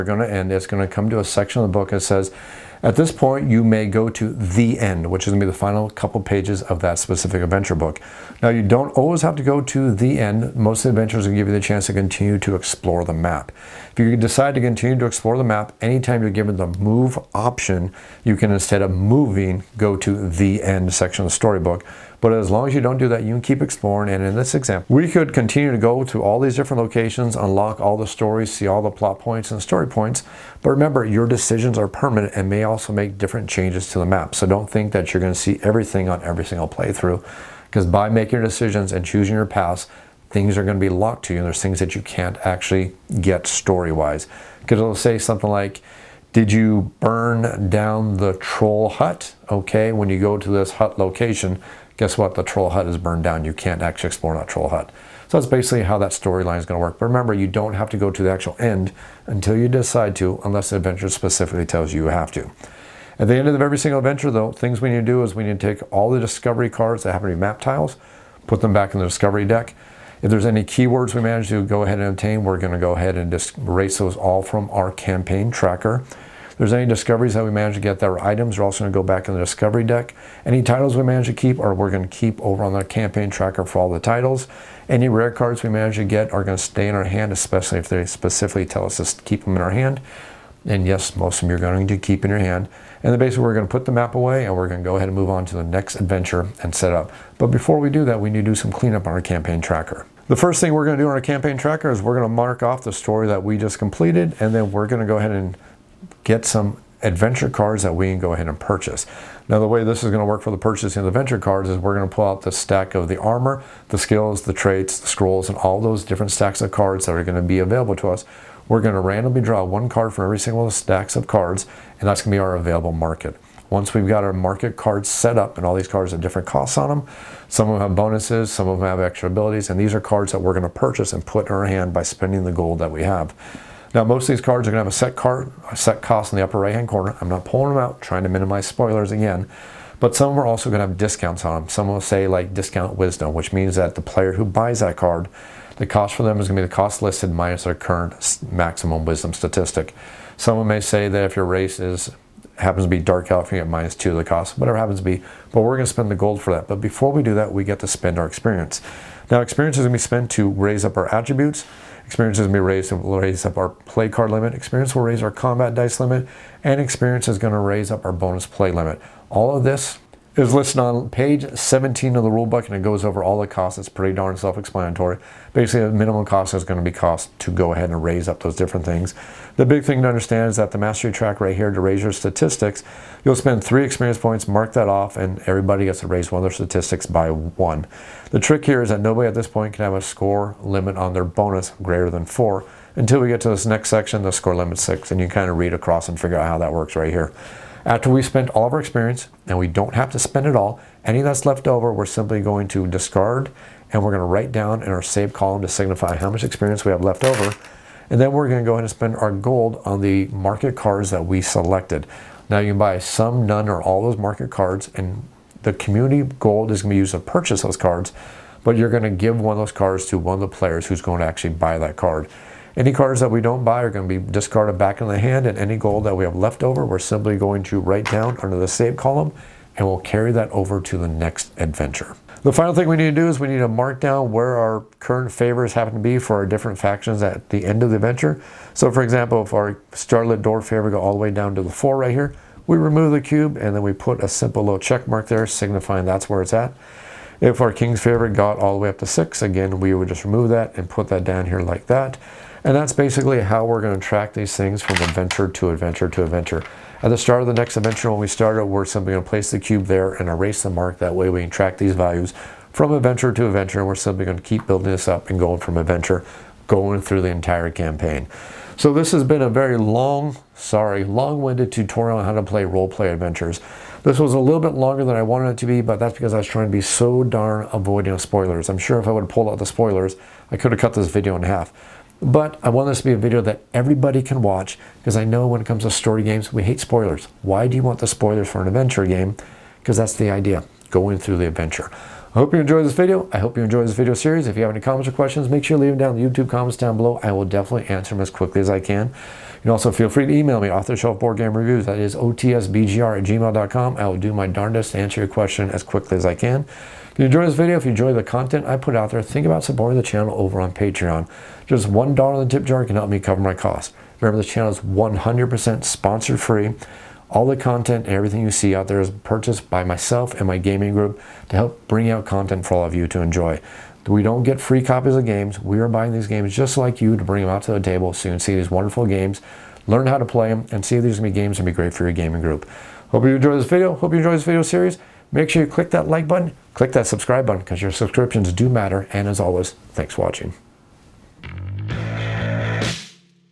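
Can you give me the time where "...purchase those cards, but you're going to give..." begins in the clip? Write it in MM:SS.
03:37.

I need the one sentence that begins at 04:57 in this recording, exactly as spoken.
I will definitely answer them as quickly as I can.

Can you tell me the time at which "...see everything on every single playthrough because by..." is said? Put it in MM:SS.
00:35.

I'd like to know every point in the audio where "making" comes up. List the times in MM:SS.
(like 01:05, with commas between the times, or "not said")
00:38.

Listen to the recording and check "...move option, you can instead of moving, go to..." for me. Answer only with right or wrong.
right.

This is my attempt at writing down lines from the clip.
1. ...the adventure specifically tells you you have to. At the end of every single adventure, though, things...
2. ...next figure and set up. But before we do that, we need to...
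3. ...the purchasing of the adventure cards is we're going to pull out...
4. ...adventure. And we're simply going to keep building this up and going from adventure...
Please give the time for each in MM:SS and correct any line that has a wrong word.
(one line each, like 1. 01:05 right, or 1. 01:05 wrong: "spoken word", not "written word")
1. 01:00 right
2. 01:35 wrong: "adventure", not "figure"
3. 01:50 right
4. 04:23 right.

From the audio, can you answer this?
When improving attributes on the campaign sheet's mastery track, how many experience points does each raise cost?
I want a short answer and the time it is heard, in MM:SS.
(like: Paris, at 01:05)
3, at 03:03.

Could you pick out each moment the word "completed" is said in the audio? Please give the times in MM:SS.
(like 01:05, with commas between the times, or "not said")
01:43.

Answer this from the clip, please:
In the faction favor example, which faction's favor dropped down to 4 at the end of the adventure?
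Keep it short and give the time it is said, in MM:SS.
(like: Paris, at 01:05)
Starlit Door, at 03:59.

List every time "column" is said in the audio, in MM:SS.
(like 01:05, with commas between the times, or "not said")
03:25, 03:48.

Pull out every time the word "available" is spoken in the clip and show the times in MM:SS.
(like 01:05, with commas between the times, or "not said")
01:57, 02:02.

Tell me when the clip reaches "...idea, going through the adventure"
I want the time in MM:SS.
04:50.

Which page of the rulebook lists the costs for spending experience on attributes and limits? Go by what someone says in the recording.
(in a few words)
17.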